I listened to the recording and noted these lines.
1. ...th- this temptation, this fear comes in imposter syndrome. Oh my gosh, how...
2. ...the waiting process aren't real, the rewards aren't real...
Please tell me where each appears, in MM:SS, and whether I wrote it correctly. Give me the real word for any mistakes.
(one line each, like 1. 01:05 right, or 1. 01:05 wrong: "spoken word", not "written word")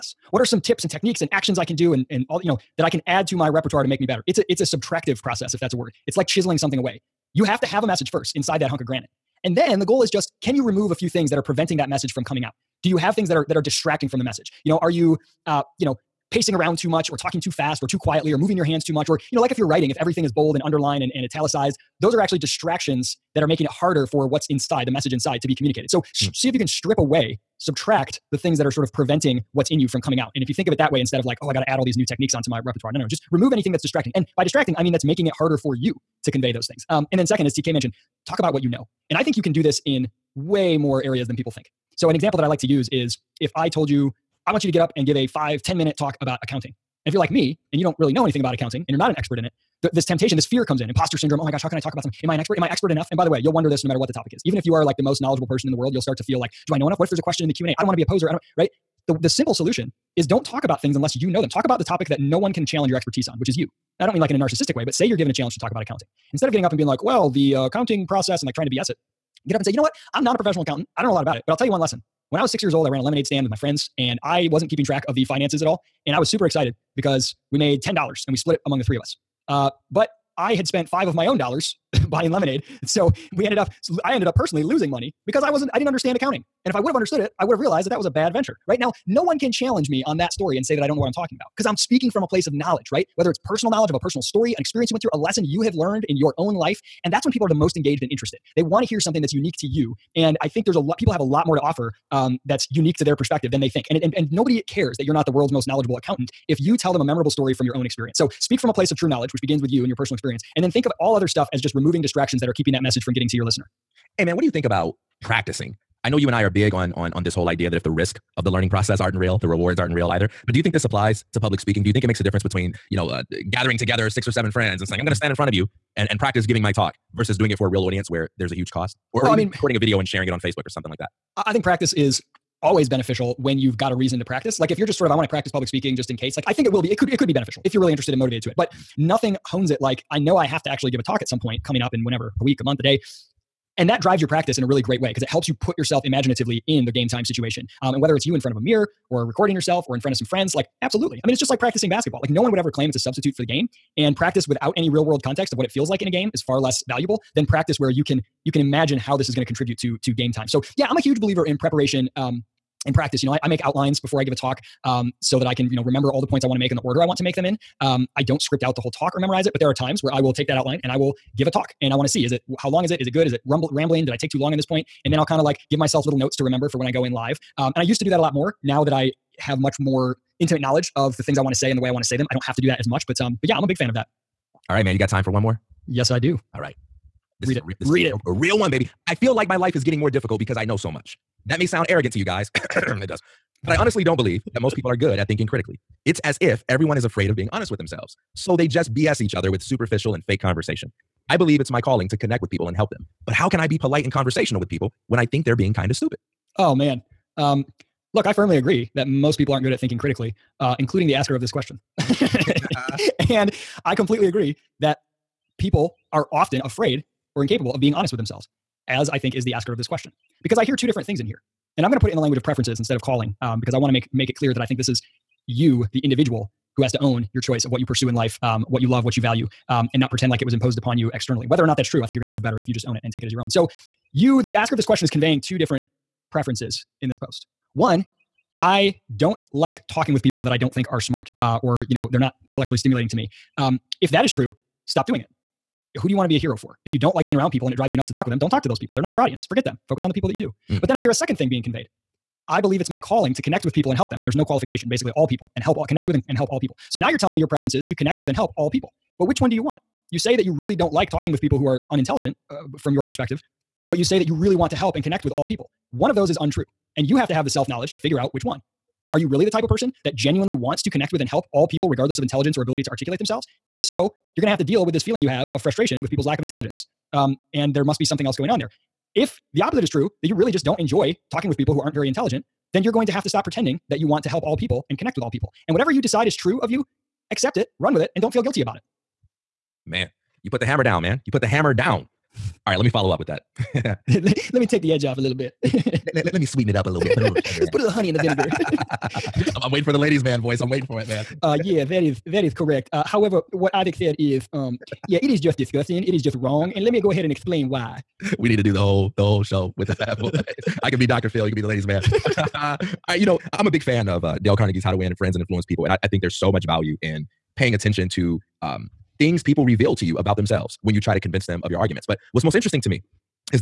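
1. 00:49 right
2. 01:58 wrong: "learning", not "waiting".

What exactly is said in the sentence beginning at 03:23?
But how can I be polite and conversational with people when I think they're being kind of stupid?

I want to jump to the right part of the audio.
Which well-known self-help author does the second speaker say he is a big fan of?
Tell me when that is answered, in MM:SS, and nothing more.
05:14.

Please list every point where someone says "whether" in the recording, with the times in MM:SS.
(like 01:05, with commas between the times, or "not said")
01:33, 02:28, 03:51.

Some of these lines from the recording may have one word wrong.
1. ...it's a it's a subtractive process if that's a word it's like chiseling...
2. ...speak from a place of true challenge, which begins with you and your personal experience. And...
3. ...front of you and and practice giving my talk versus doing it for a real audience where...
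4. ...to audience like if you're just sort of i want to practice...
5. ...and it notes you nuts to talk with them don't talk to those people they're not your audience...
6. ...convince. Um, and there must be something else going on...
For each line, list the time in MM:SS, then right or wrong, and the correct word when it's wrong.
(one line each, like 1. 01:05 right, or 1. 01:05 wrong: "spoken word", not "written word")
1. 00:04 right
2. 01:48 wrong: "knowledge", not "challenge"
3. 02:05 right
4. 02:14 wrong: "practice", not "audience"
5. 04:07 wrong: "drives", not "notes"
6. 04:36 wrong: "intelligence", not "convince".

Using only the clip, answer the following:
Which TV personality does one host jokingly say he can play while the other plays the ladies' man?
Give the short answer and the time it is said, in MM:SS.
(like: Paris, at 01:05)
Dr. Phil, at 05:11.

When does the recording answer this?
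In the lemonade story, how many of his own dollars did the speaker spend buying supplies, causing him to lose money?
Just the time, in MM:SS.
01:20.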